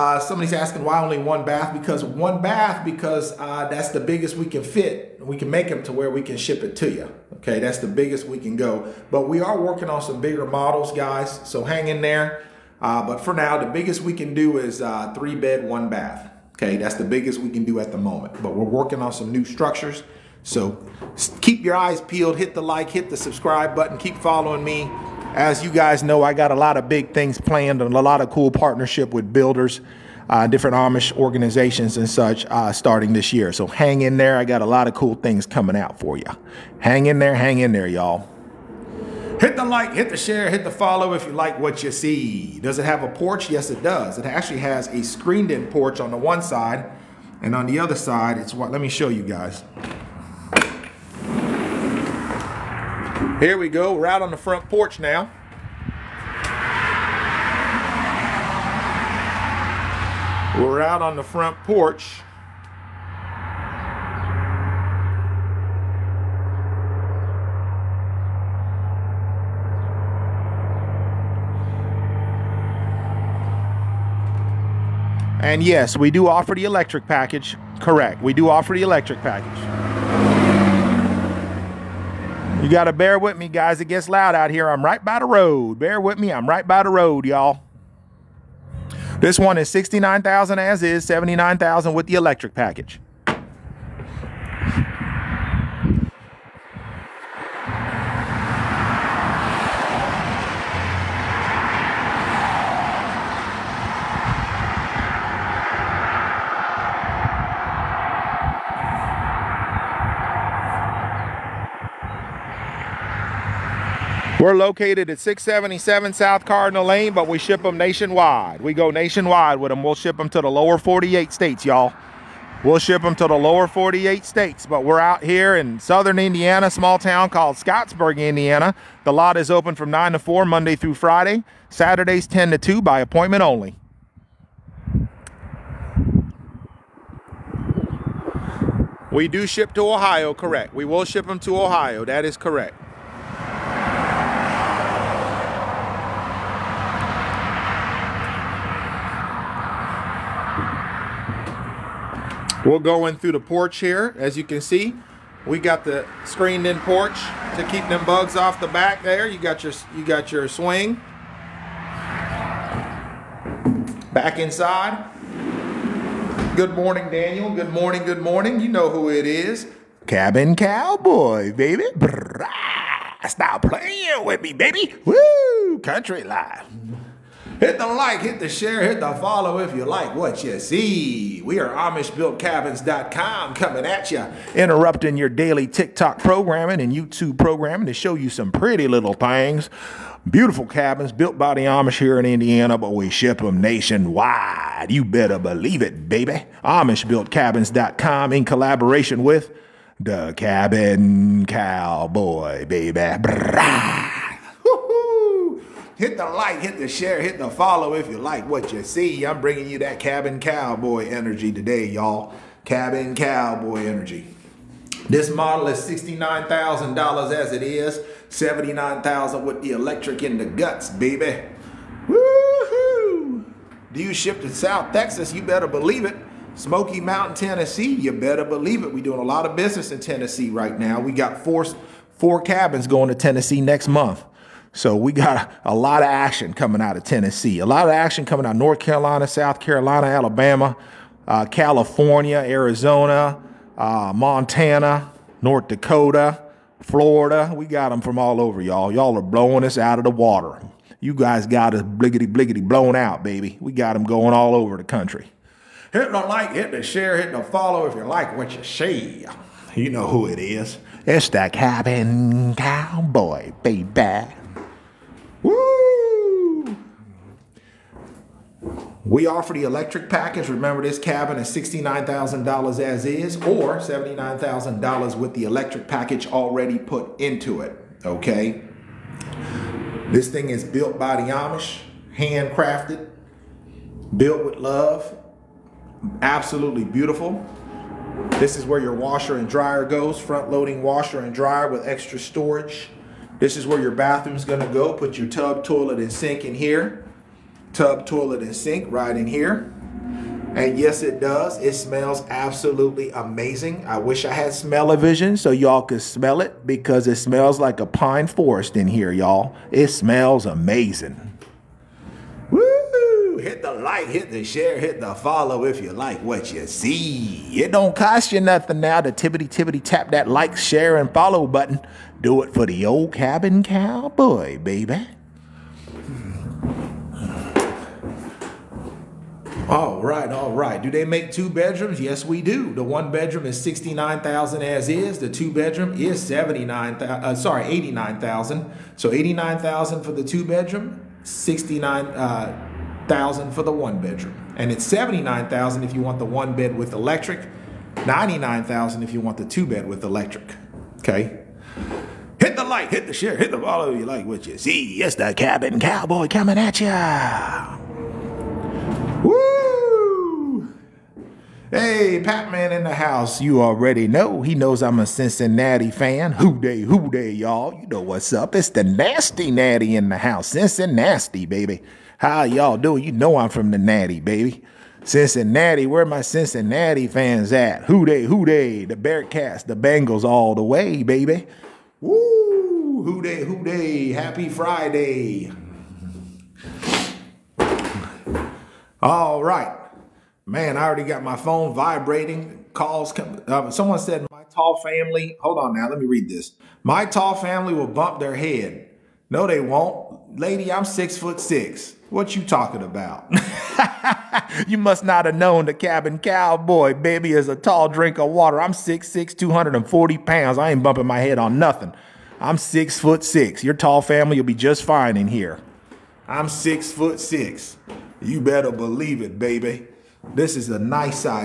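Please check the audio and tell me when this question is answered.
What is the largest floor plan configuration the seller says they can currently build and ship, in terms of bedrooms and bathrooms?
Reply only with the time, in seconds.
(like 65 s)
15 s.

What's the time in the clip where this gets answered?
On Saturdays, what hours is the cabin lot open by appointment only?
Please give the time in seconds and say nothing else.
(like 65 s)
131 s.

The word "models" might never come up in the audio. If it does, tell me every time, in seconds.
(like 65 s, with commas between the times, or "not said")
10 s, 215 s.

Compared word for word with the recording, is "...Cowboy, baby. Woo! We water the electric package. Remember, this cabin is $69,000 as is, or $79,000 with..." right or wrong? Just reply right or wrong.
wrong.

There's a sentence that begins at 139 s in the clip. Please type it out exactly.
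We do ship to Ohio, correct.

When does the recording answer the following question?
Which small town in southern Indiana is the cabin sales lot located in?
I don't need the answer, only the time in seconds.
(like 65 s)
127 s.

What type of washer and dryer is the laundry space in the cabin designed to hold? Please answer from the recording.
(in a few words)
front loading.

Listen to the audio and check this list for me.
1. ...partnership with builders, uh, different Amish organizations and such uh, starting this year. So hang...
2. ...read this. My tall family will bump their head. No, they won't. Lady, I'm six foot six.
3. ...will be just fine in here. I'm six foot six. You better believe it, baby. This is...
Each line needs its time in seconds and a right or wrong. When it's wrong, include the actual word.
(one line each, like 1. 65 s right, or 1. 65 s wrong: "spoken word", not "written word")
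1. 28 s right
2. 396 s right
3. 414 s right.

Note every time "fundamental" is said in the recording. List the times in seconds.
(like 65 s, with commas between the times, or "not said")
not said.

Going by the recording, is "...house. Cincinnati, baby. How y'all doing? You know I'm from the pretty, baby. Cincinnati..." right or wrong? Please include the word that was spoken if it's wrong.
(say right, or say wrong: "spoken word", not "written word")
wrong: "natty", not "pretty".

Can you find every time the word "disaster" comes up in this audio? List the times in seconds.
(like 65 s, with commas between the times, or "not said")
not said.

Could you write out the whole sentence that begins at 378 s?
The Bearcats, the Bengals all the way, baby.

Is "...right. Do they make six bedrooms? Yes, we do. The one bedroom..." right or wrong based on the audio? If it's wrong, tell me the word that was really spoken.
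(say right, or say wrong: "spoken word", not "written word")
wrong: "two", not "six".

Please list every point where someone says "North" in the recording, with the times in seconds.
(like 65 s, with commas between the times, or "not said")
238 s, 245 s.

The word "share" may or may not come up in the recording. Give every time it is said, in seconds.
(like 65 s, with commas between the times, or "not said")
40 s, 178 s, 206 s, 256 s, 314 s, 320 s, 353 s.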